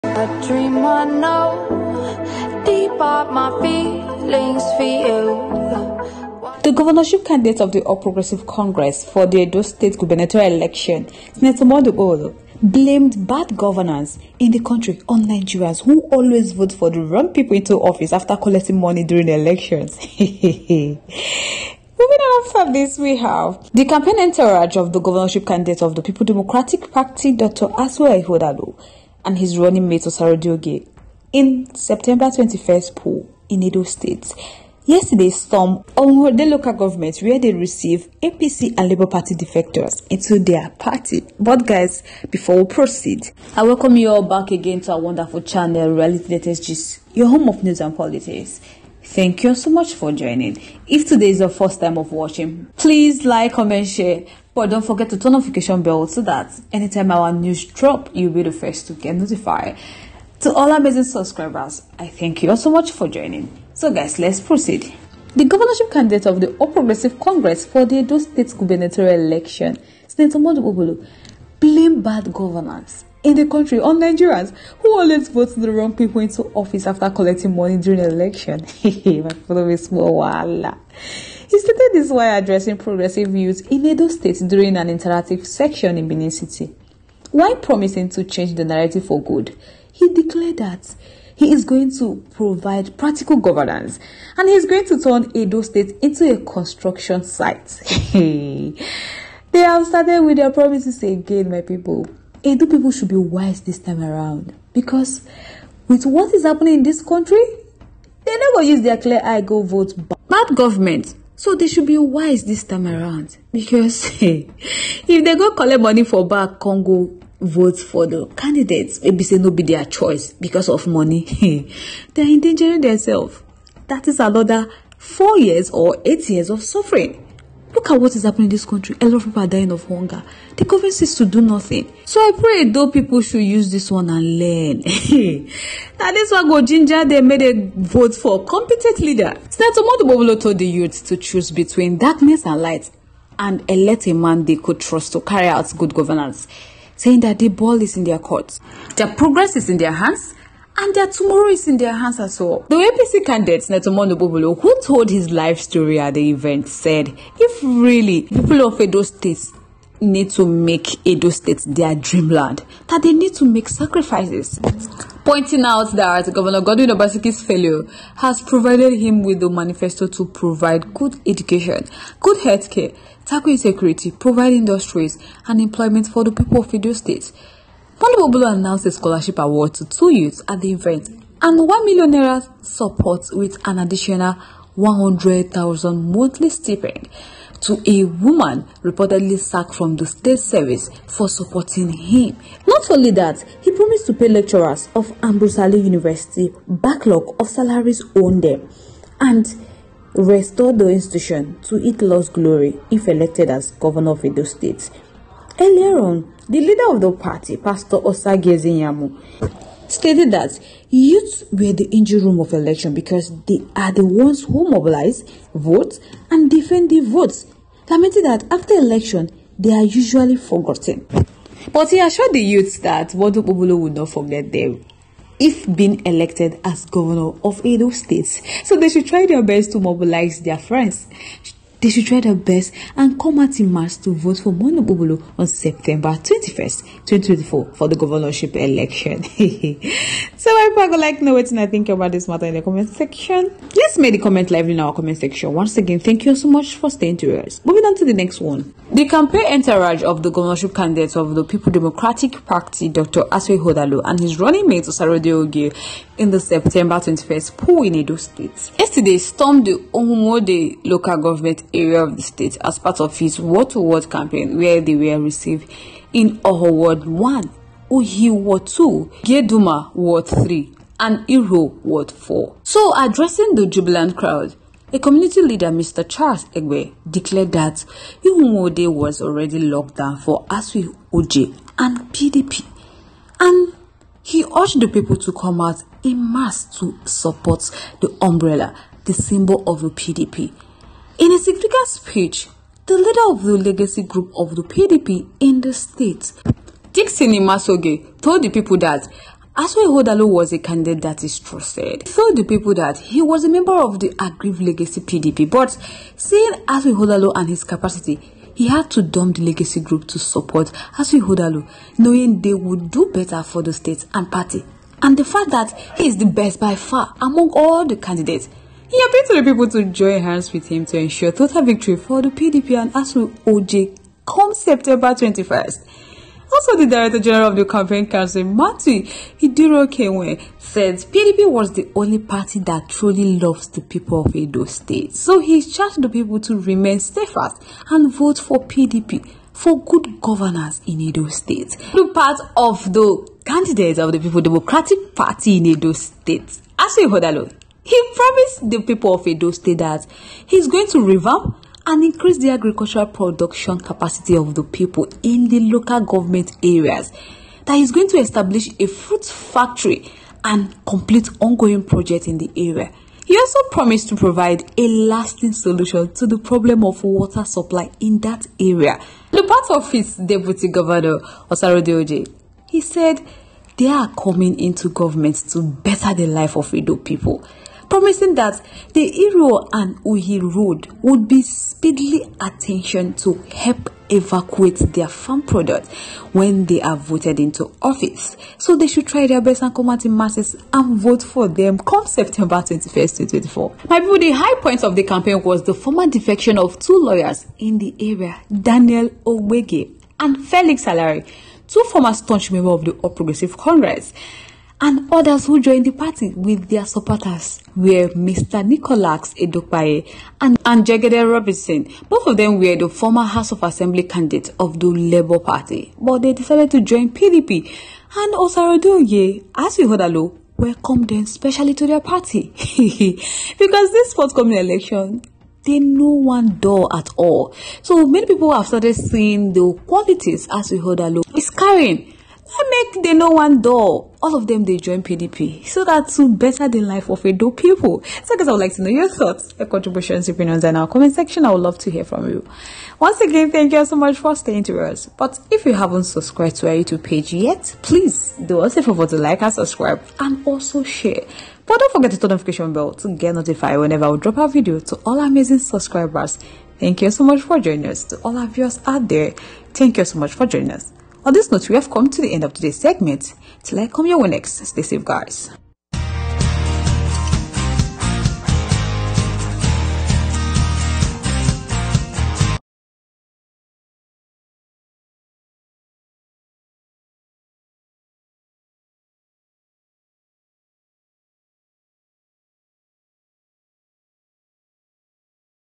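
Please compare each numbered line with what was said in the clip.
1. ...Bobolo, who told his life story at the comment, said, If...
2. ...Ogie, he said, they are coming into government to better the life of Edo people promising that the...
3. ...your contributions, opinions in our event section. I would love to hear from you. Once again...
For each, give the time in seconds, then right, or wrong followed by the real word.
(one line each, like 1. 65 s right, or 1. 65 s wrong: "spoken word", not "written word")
1. 154 s wrong: "event", not "comment"
2. 372 s right
3. 439 s wrong: "comment", not "event".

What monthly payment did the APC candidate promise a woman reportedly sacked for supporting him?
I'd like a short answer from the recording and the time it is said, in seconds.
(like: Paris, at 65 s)
100,000 naira, at 184 s.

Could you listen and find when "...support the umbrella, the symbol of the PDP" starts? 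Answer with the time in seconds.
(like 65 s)
287 s.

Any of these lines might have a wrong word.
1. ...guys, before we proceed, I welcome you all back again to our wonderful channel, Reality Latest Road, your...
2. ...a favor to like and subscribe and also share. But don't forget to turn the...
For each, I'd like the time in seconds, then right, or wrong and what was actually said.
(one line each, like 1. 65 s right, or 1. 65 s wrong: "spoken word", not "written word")
1. 41 s wrong: "Gist", not "Road"
2. 448 s right.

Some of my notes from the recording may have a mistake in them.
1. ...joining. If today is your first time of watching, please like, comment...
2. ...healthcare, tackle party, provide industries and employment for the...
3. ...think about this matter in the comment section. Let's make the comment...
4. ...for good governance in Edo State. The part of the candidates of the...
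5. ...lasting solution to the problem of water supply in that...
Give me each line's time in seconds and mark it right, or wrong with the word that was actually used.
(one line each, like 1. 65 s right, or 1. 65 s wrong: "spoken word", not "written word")
1. 50 s right
2. 172 s wrong: "insecurity", not "party"
3. 241 s right
4. 339 s right
5. 364 s right.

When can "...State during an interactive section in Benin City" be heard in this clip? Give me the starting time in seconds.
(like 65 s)
84 s.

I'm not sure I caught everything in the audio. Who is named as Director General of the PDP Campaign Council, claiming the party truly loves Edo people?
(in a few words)
Matthew Idirokewe.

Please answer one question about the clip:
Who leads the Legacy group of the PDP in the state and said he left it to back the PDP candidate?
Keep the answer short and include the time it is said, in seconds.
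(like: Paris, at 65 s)
Dixon Imasogie, at 296 s.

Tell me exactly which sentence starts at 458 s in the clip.
To all our viewers out there, thank you so much for joining us.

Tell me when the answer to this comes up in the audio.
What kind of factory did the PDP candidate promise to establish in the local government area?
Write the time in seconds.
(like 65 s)
358 s.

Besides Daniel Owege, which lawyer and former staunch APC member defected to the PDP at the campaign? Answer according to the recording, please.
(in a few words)
Felix Salari.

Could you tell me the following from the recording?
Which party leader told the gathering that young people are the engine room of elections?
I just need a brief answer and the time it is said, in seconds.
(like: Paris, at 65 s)
Osagie Ize-Iyamu, at 207 s.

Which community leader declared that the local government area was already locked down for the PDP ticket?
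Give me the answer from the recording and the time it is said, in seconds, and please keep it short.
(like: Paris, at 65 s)
Charles Egwe, at 275 s.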